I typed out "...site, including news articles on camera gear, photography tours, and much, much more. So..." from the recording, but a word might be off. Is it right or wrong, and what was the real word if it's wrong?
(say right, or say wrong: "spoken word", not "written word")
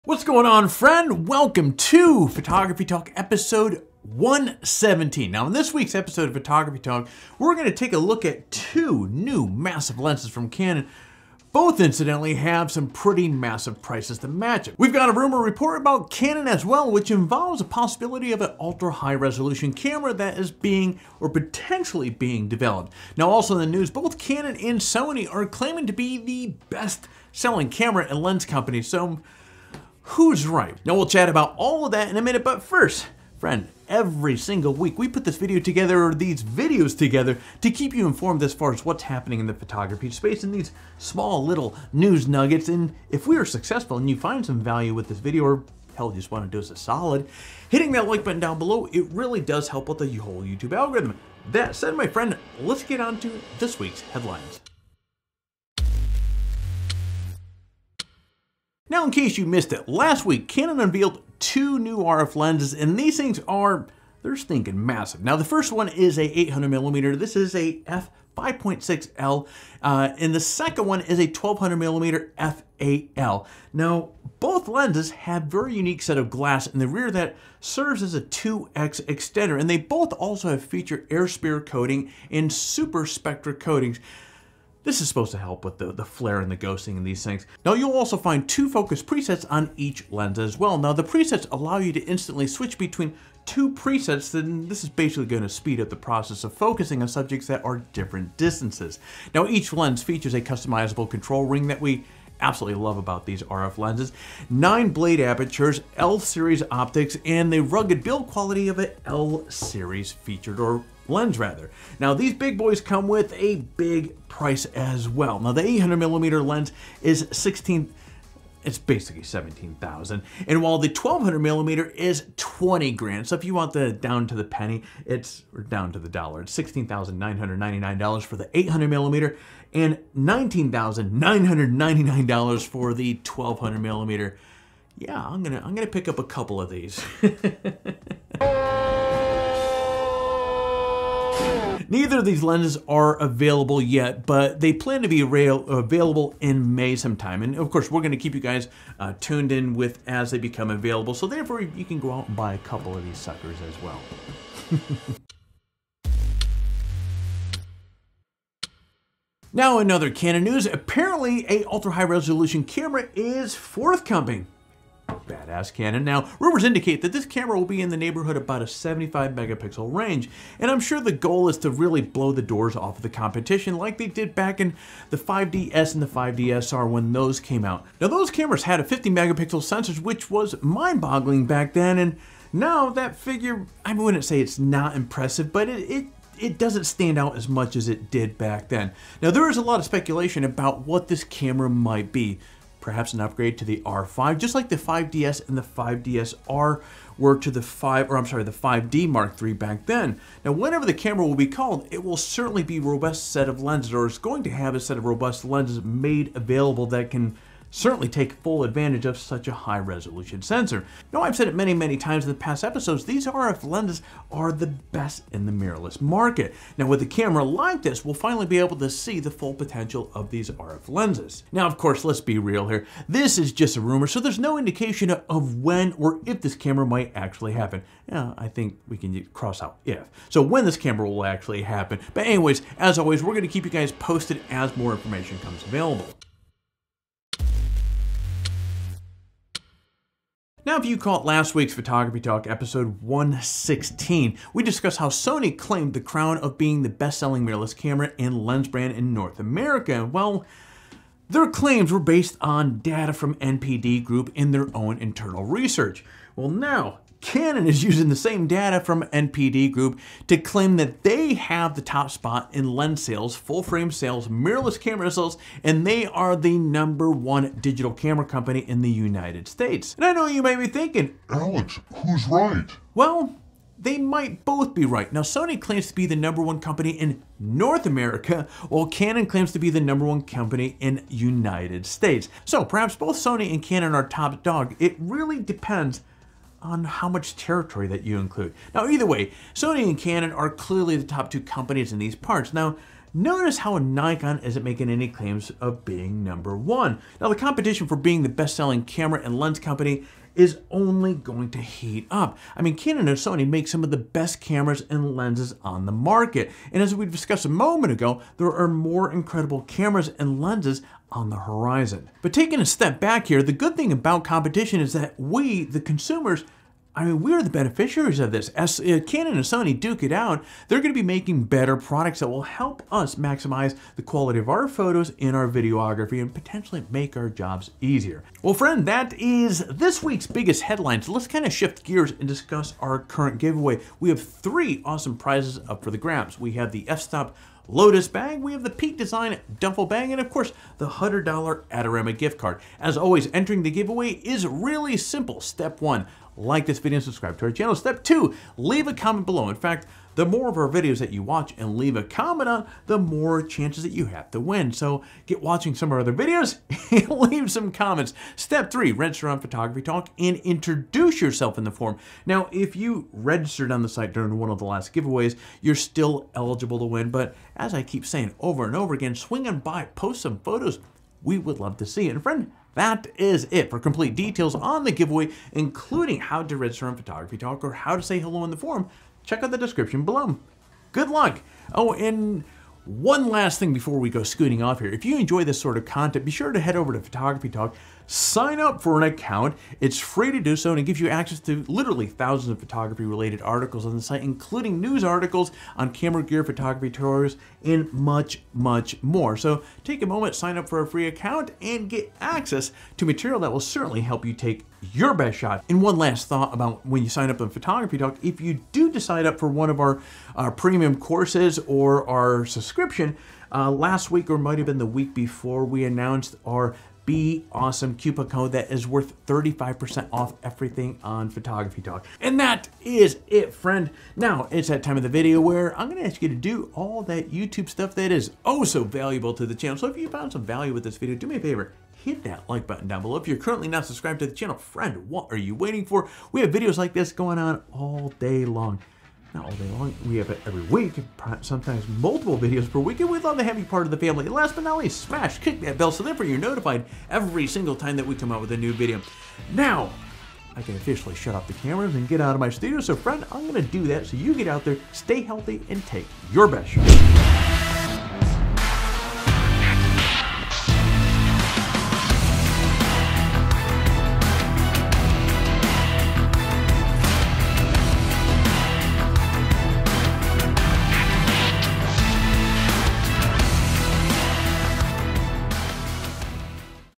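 right.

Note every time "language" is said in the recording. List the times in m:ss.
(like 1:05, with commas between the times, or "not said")
not said.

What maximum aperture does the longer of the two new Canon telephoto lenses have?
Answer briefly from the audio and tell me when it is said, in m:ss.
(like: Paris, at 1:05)
f/8, at 1:12.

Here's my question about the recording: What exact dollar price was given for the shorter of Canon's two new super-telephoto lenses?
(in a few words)
$16,999.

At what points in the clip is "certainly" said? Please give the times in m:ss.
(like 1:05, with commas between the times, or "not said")
3:22, 3:27, 6:43.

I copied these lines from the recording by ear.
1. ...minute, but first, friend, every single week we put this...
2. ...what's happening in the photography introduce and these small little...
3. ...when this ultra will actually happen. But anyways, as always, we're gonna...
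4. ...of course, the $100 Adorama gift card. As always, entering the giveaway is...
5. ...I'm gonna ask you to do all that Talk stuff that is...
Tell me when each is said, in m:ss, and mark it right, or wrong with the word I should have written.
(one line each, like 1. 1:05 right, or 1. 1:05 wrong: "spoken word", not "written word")
1. 0:32 right
2. 0:38 wrong: "space", not "introduce"
3. 3:50 wrong: "camera", not "ultra"
4. 5:40 right
5. 7:05 wrong: "YouTube", not "Talk".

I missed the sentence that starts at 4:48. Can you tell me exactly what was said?
Now, either way, Sony and Canon are clearly the top two companies in these parts.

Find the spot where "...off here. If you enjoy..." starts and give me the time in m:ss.
6:24.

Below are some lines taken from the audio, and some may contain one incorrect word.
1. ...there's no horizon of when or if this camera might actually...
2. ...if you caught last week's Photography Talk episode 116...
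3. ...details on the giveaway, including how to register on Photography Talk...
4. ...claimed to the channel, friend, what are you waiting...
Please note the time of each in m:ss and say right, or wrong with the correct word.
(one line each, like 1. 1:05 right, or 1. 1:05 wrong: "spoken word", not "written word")
1. 3:44 wrong: "indication", not "horizon"
2. 4:00 right
3. 6:14 right
4. 7:13 wrong: "subscribed", not "claimed".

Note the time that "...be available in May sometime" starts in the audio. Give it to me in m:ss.
2:25.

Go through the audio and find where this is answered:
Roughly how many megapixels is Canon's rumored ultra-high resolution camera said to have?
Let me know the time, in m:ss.
2:48.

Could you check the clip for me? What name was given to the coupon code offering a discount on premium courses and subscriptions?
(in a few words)
Be Awesome.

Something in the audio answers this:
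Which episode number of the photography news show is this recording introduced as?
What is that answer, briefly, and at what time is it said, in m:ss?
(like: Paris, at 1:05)
117, at 0:03.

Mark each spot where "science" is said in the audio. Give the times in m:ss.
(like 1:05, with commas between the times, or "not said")
not said.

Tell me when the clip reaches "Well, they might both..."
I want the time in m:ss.
4:32.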